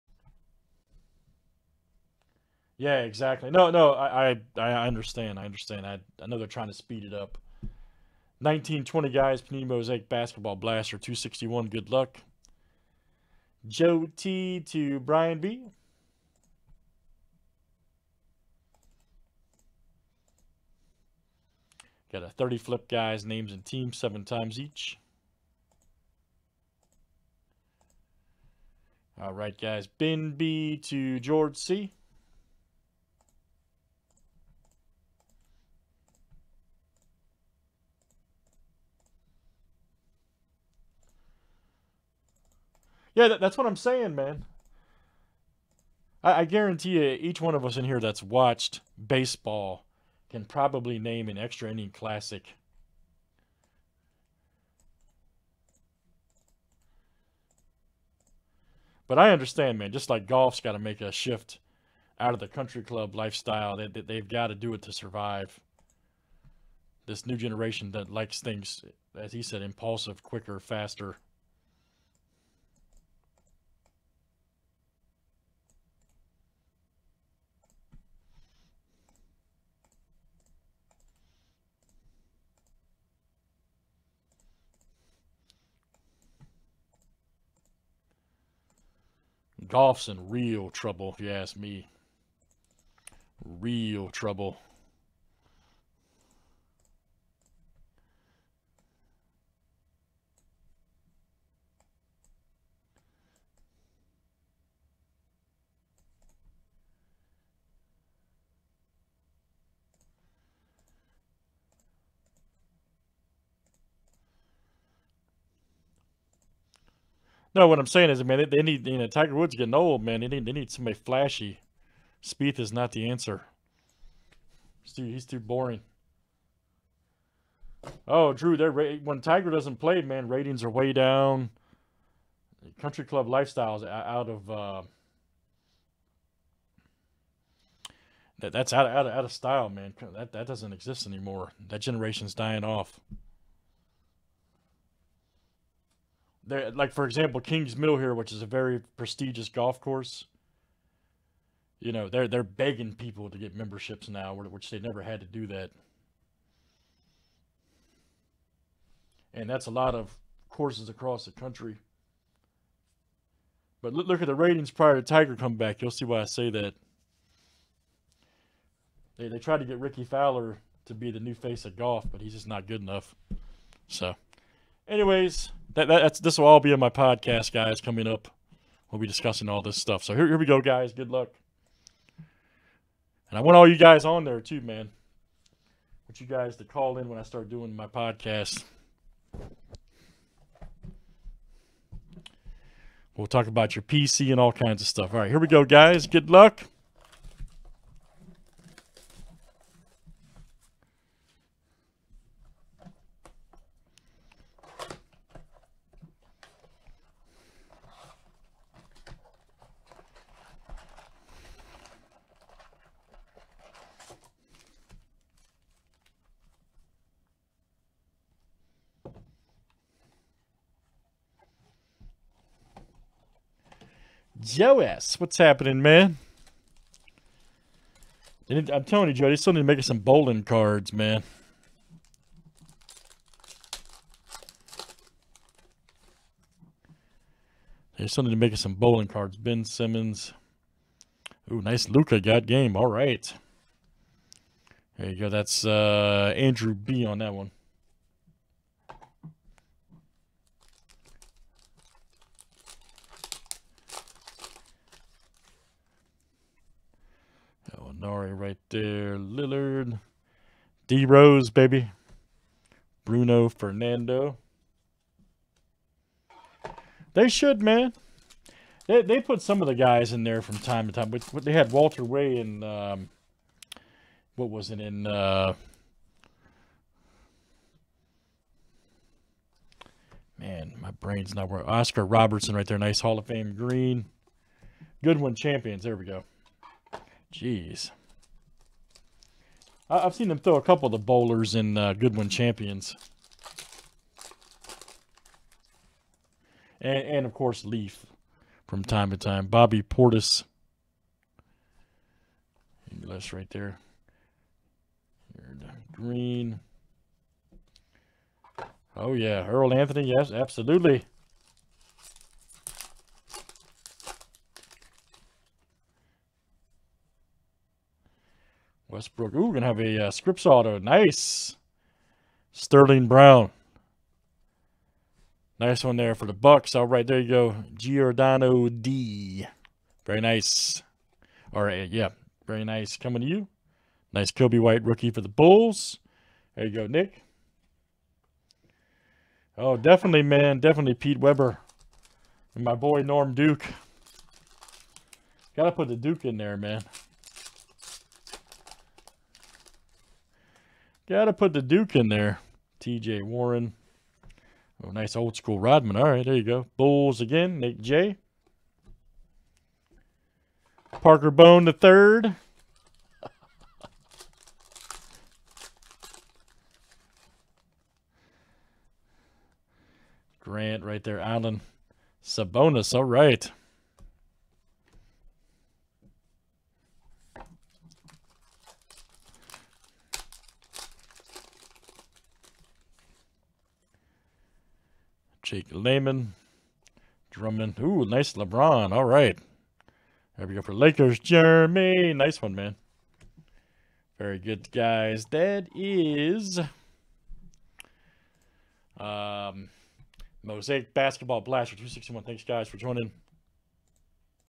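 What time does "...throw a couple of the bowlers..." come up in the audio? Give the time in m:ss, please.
4:50.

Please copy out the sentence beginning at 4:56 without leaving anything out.
And, and, of course, Leaf from time to time.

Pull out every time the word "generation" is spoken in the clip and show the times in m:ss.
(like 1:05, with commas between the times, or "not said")
1:07, 2:21.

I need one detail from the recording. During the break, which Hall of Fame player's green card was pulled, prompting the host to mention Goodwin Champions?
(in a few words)
Oscar Robertson.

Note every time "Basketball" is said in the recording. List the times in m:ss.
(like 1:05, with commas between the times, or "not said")
0:10, 6:40.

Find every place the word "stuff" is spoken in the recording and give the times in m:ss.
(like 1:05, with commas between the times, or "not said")
2:59, 3:14.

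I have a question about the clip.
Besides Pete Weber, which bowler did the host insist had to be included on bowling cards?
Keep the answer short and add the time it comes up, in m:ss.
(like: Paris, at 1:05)
Norm Duke, at 5:43.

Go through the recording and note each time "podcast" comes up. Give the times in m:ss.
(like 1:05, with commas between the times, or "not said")
2:56, 3:07.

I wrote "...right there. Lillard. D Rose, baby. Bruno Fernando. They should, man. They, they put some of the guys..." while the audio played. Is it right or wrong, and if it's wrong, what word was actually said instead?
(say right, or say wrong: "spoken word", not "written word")
right.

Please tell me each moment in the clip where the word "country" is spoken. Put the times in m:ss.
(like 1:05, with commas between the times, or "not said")
1:02, 2:12, 2:41.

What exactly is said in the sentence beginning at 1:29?
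golf's in real trouble, if you ask me.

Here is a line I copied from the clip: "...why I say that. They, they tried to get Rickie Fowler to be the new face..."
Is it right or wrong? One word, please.
right.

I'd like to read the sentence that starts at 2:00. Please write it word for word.
They need they need somebody flashy.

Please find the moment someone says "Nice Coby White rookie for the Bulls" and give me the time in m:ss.
5:34.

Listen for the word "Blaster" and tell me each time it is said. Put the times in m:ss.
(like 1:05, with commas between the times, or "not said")
0:10, 6:41.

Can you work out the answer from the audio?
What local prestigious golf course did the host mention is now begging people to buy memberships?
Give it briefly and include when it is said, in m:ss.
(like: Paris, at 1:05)
Kings Mill, at 2:27.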